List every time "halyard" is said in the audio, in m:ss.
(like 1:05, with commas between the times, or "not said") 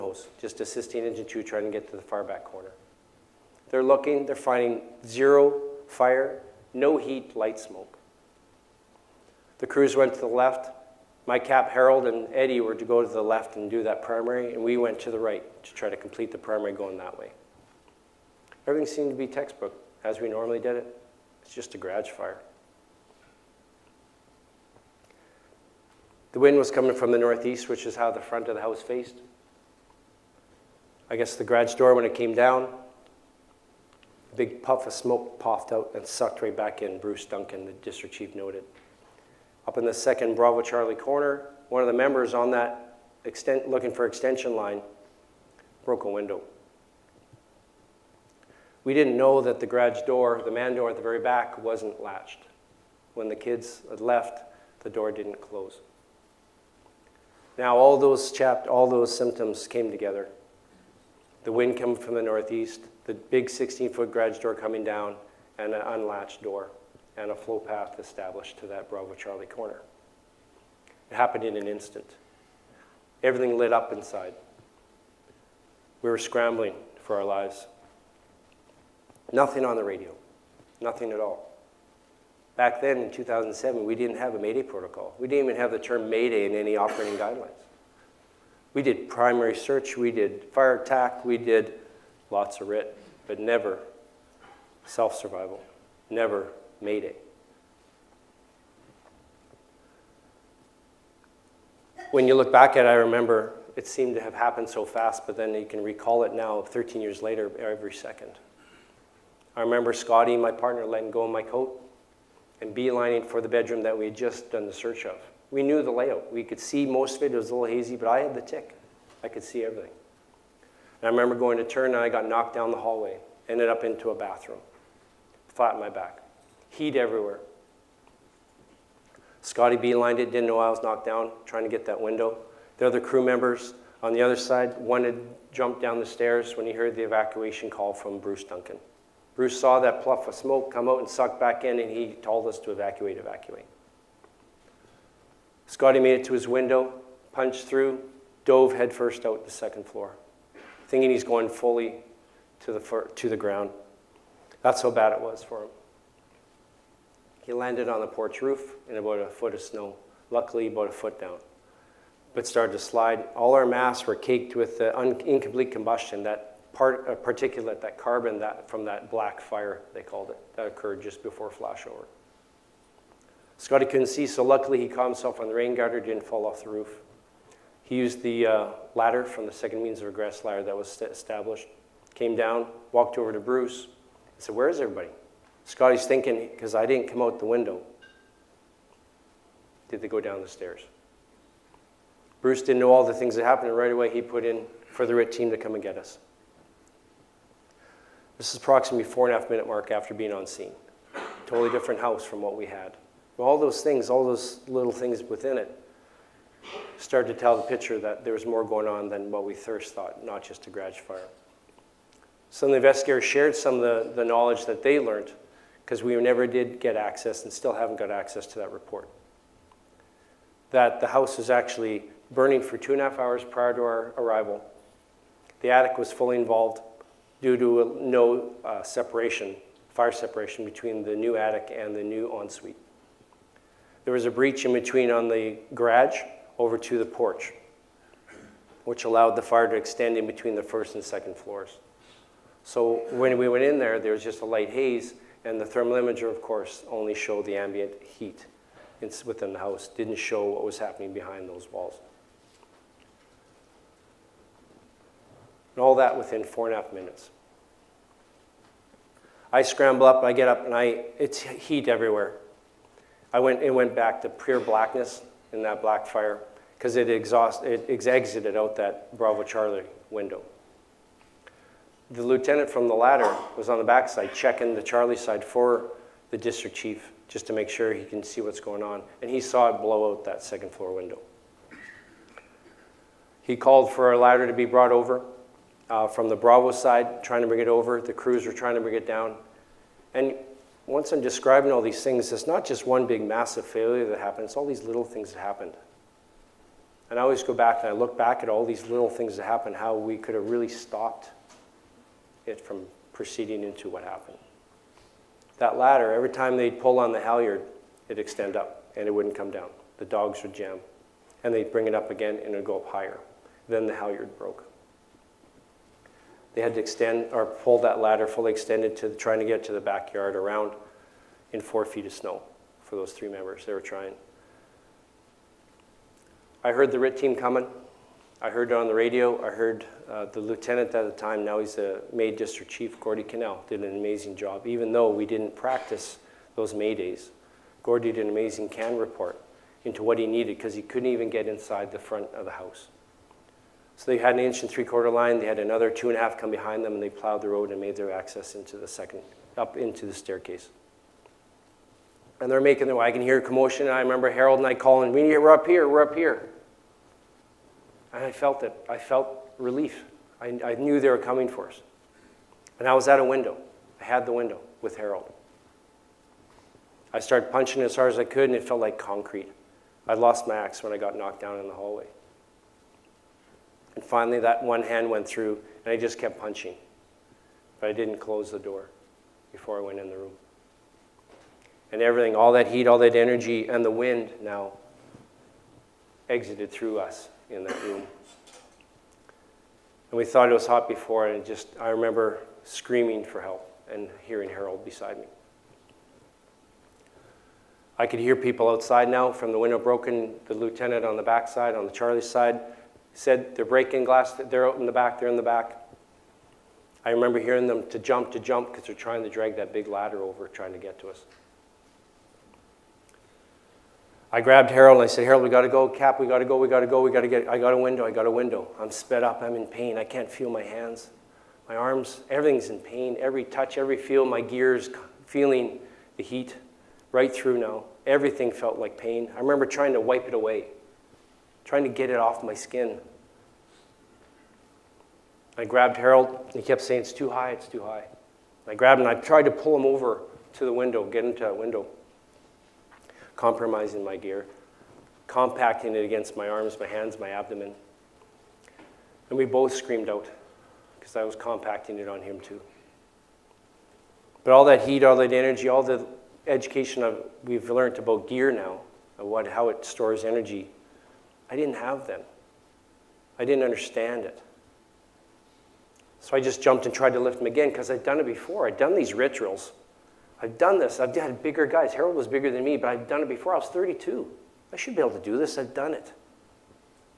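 5:07, 5:13.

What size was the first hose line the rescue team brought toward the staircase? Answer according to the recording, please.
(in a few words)
inch and three quarter.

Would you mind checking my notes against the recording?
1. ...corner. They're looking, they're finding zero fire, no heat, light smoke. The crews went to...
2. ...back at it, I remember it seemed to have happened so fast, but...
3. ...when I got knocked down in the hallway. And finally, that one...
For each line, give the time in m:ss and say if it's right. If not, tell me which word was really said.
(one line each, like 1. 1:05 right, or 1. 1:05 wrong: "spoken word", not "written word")
1. 0:02 right
2. 1:42 right
3. 6:10 right.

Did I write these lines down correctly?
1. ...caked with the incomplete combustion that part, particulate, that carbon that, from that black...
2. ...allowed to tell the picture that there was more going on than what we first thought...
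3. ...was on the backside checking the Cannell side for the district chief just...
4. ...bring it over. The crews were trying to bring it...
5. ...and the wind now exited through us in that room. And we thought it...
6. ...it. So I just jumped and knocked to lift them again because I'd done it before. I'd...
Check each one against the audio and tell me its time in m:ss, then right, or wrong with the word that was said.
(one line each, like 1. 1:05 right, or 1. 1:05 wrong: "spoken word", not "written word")
1. 2:44 right
2. 3:26 wrong: "started", not "allowed"
3. 4:33 wrong: "Charlie", not "Cannell"
4. 4:47 right
5. 6:23 right
6. 7:44 wrong: "tried", not "knocked".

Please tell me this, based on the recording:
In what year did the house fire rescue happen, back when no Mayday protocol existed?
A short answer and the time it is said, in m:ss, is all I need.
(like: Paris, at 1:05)
2007, at 1:23.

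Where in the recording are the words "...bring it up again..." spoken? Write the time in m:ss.
5:11.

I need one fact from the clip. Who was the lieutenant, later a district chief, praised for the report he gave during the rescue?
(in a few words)
Gordy Cannell.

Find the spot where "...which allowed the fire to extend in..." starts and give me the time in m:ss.
3:58.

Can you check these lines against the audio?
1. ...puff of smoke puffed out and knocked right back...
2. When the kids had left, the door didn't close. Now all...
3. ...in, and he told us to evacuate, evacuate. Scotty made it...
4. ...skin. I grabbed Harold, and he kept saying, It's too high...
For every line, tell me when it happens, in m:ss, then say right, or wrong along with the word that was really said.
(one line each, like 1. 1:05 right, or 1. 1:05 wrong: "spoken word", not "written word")
1. 0:34 wrong: "sucked", not "knocked"
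2. 0:53 right
3. 2:21 right
4. 7:12 right.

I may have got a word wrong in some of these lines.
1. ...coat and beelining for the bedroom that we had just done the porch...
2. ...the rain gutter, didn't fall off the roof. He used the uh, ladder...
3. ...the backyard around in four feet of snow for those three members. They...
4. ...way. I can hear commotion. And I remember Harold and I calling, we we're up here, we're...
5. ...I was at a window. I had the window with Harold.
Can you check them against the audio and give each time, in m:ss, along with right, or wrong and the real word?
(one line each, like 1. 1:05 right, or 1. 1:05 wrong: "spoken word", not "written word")
1. 1:51 wrong: "search", not "porch"
2. 2:55 right
3. 5:19 right
4. 5:52 right
5. 6:02 right.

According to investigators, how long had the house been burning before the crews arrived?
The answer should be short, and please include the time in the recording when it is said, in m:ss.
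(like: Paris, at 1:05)
two and a half hours, at 3:42.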